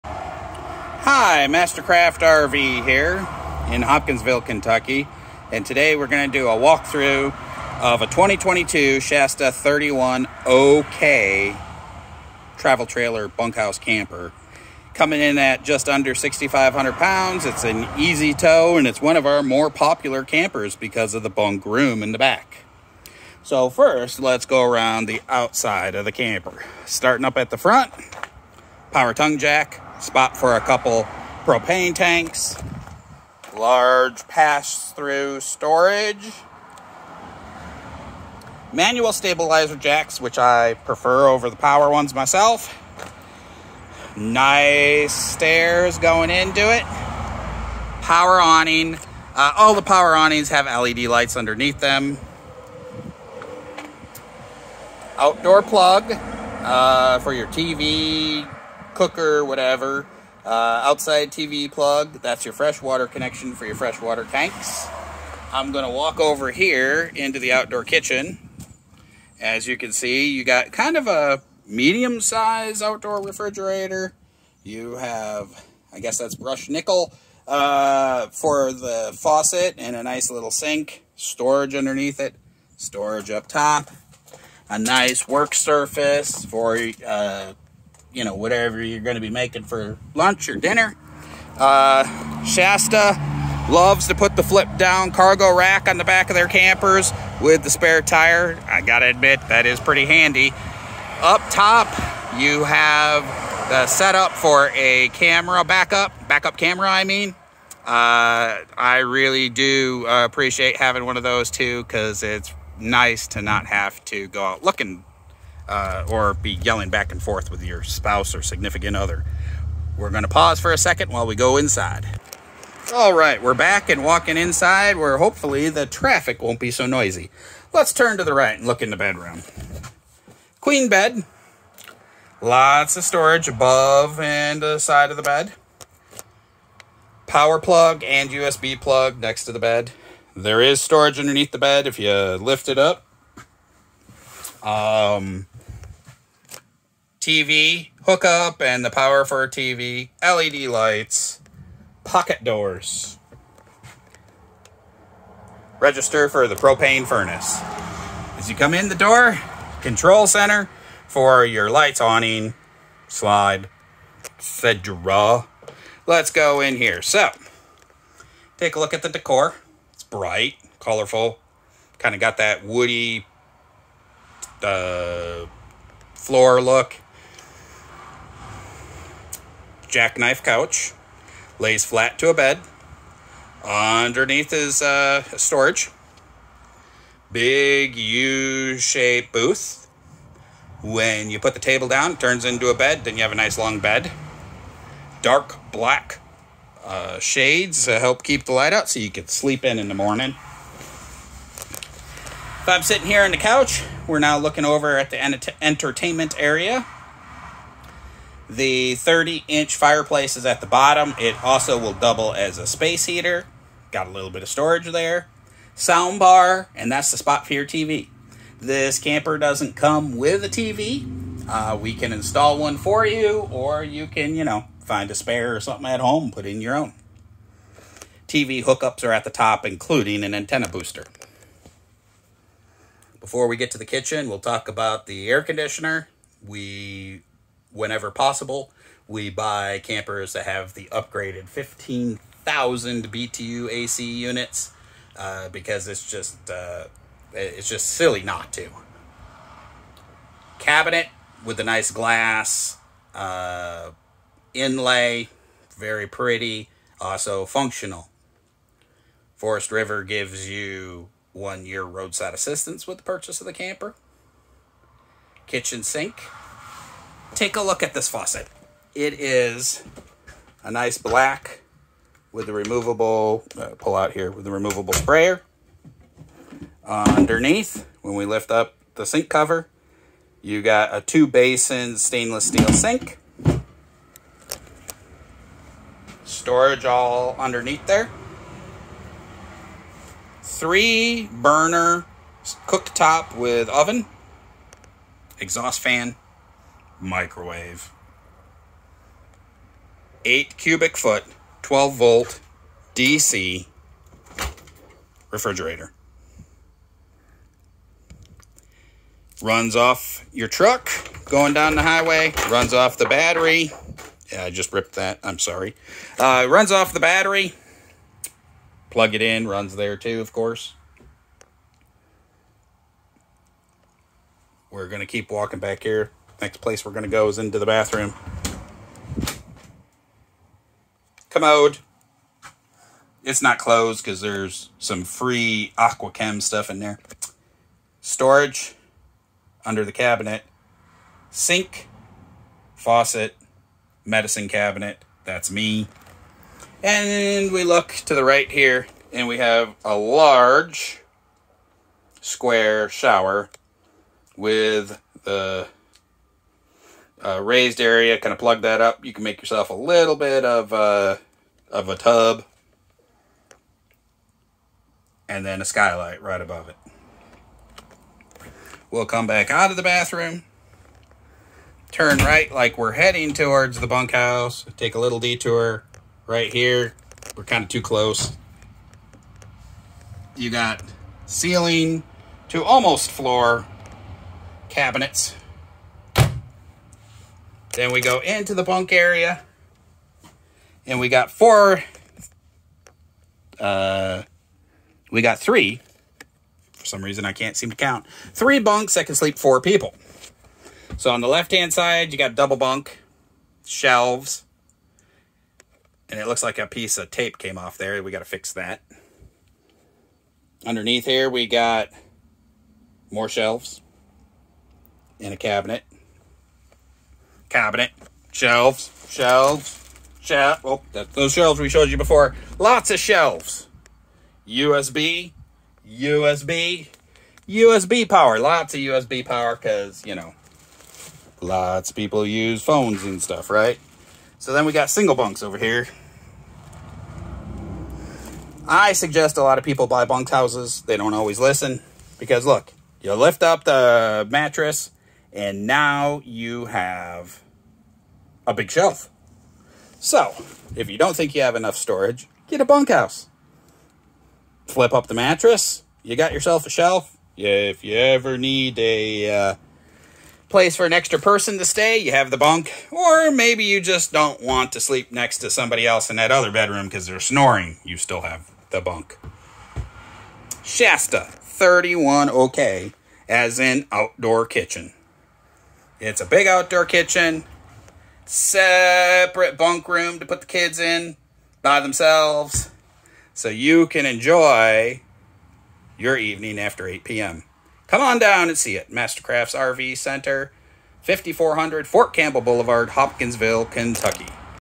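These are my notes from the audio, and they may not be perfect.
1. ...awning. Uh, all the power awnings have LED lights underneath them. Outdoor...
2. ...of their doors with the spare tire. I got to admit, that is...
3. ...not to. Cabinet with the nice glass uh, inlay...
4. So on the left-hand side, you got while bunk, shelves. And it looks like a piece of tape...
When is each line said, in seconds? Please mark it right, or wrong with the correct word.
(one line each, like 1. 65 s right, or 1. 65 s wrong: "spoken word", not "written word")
1. 48 s right
2. 96 s wrong: "campers", not "doors"
3. 248 s right
4. 400 s wrong: "double", not "while".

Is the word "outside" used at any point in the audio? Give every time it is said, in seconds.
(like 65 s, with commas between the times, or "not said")
25 s, 60 s.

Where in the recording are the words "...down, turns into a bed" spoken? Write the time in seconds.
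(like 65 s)
191 s.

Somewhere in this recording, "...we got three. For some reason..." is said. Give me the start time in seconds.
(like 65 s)
395 s.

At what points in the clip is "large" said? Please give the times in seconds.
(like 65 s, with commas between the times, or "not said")
33 s, 349 s.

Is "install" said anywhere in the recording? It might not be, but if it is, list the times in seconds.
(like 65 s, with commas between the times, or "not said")
222 s.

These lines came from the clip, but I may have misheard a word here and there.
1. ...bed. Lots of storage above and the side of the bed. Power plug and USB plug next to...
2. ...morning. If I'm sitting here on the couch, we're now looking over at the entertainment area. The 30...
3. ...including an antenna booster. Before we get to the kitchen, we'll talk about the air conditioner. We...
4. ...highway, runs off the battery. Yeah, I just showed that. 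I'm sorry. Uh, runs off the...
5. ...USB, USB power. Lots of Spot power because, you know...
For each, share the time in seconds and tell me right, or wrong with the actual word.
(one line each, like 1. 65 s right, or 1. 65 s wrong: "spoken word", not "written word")
1. 130 s right
2. 199 s right
3. 229 s right
4. 311 s wrong: "ripped", not "showed"
5. 425 s wrong: "USB", not "Spot".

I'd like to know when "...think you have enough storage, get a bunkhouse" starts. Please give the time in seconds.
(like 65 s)
451 s.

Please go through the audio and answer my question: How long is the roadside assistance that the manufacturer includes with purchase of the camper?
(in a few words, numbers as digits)
one year.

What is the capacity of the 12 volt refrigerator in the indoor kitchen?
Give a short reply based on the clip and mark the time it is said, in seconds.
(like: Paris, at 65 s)
8 cubic foot, at 300 s.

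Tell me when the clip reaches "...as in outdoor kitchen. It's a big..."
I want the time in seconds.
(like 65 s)
473 s.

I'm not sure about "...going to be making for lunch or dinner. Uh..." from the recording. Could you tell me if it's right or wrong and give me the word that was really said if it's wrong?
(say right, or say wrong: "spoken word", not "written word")
right.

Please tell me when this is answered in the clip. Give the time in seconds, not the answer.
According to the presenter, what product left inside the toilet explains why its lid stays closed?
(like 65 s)
335 s.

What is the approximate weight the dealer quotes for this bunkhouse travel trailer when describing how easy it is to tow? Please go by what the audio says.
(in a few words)
6,500 pounds.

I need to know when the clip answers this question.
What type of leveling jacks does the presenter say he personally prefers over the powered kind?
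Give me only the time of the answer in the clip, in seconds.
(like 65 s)
38 s.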